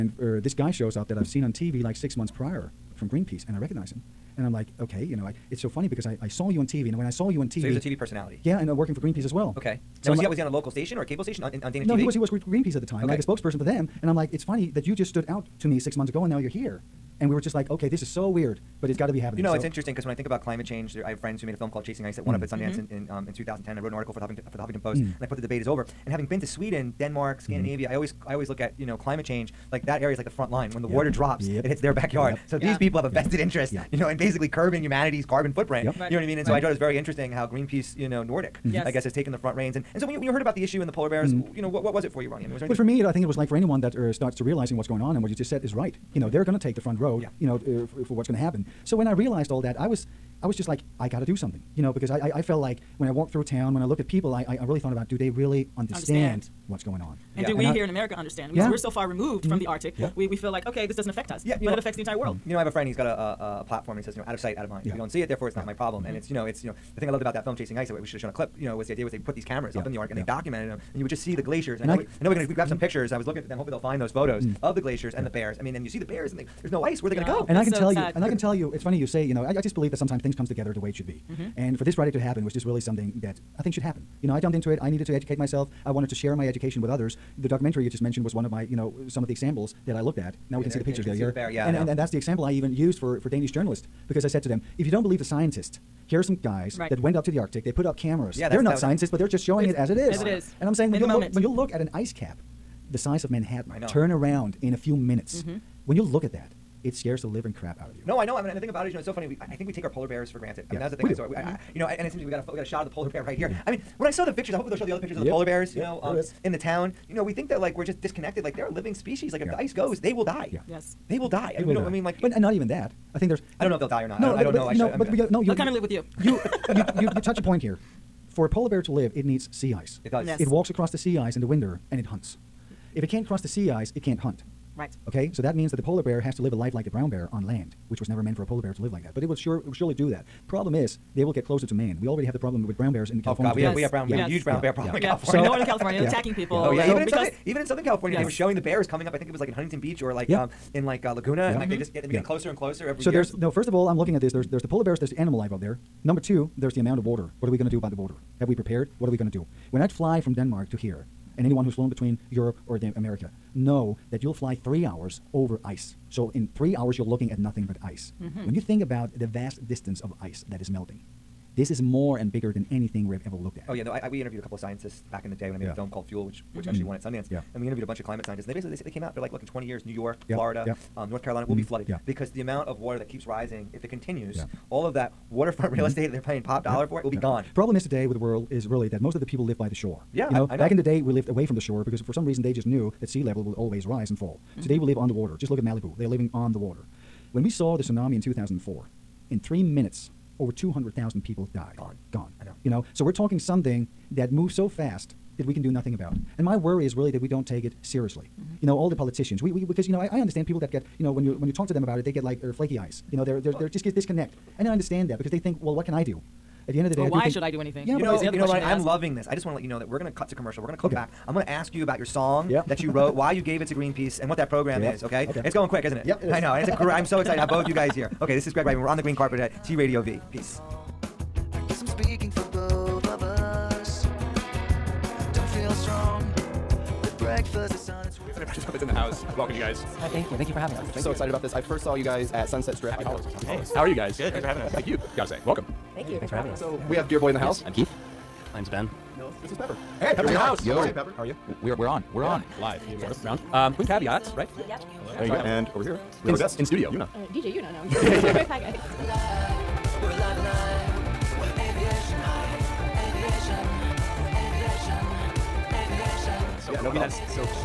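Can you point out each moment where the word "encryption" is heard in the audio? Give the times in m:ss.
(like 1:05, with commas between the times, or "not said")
not said.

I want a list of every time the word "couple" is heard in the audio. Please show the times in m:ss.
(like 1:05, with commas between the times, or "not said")
2:54.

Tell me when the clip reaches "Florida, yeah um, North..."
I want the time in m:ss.
3:00.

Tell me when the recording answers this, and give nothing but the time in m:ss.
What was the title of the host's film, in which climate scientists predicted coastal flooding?
2:56.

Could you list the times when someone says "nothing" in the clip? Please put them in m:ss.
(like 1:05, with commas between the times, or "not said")
2:47, 3:25.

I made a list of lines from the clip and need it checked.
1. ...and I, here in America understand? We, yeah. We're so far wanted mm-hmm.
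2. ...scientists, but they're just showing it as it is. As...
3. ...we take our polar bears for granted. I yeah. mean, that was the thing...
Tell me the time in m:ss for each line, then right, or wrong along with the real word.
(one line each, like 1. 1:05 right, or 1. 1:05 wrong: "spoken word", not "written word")
1. 0:57 wrong: "removed", not "wanted"
2. 1:38 right
3. 1:49 right.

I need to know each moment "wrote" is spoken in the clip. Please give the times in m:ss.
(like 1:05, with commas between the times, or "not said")
0:23, 3:42.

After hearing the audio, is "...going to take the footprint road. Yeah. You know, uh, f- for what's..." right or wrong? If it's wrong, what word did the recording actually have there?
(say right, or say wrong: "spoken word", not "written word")
wrong: "front", not "footprint".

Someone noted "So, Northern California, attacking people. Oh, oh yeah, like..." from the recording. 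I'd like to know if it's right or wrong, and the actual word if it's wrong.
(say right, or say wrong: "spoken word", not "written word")
right.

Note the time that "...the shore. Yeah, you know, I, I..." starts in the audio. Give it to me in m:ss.
3:09.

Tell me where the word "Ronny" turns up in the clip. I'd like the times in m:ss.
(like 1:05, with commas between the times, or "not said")
0:42.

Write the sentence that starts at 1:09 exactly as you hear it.
up in the Arctic and yeah.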